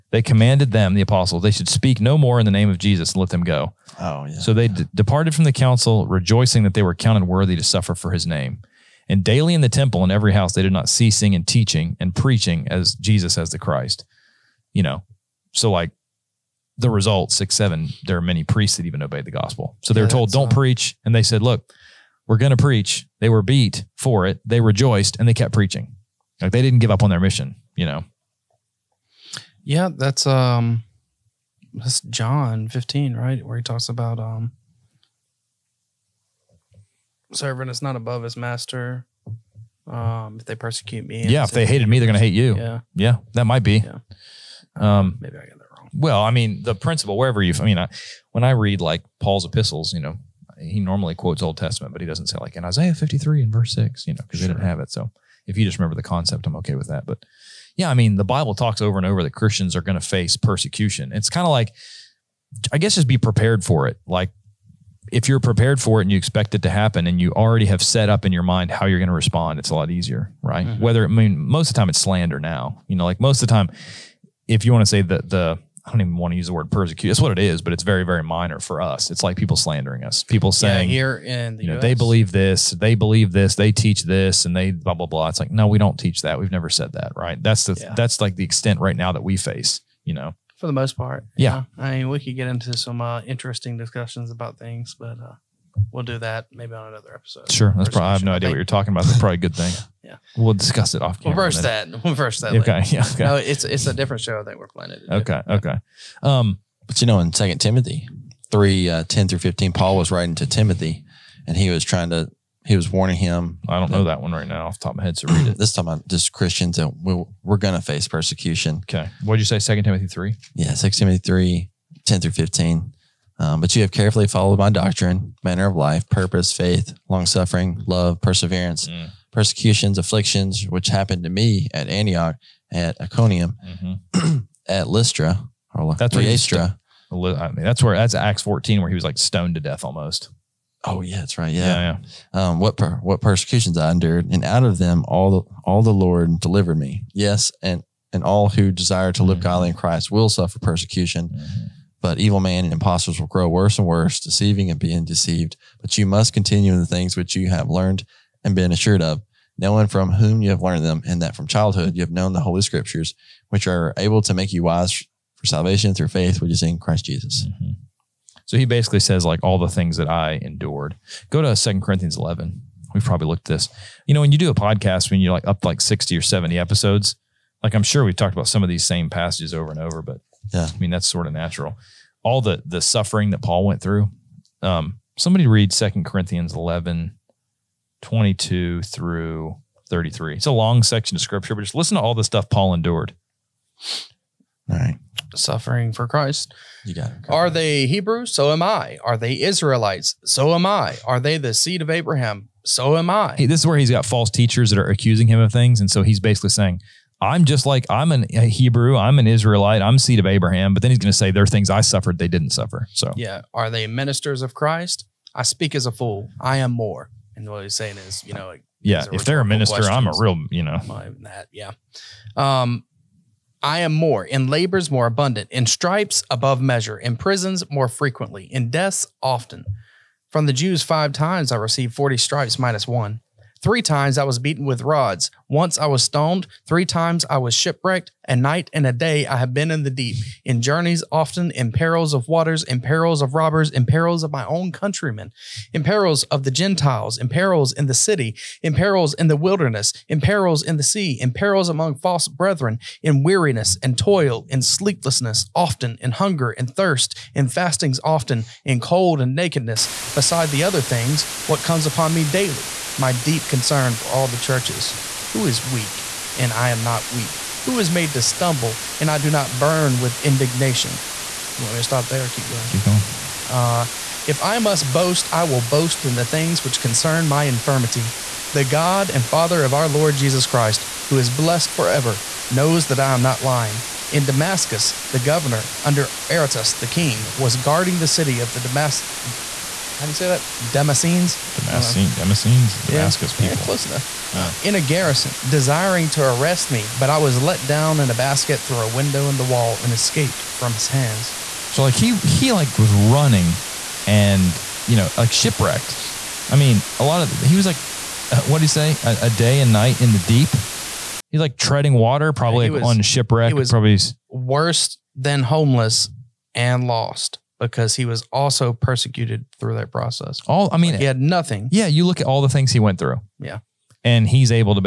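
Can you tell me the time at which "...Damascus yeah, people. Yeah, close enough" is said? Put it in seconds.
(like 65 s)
292 s.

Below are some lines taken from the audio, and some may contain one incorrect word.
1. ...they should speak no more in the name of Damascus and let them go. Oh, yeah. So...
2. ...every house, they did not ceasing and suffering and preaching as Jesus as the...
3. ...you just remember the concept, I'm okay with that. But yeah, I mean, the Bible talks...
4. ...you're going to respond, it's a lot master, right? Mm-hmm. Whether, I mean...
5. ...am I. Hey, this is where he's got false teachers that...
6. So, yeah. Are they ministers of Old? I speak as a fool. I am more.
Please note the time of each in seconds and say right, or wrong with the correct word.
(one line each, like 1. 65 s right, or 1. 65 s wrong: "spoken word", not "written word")
1. 1 s wrong: "Jesus", not "Damascus"
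2. 10 s wrong: "teaching", not "suffering"
3. 55 s right
4. 68 s wrong: "easier", not "master"
5. 202 s right
6. 212 s wrong: "Christ", not "Old".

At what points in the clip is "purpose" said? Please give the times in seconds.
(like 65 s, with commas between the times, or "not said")
126 s.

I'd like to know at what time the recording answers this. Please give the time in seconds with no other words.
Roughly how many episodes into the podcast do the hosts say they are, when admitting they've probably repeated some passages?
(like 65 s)
175 s.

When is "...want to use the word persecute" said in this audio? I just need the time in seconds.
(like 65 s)
76 s.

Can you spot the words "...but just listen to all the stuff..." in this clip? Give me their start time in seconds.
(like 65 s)
191 s.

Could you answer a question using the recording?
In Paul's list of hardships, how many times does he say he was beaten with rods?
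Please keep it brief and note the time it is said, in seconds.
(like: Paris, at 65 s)
3, at 233 s.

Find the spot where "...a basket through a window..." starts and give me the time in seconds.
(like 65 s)
298 s.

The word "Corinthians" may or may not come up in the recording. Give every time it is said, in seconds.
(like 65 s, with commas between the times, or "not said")
171 s, 186 s.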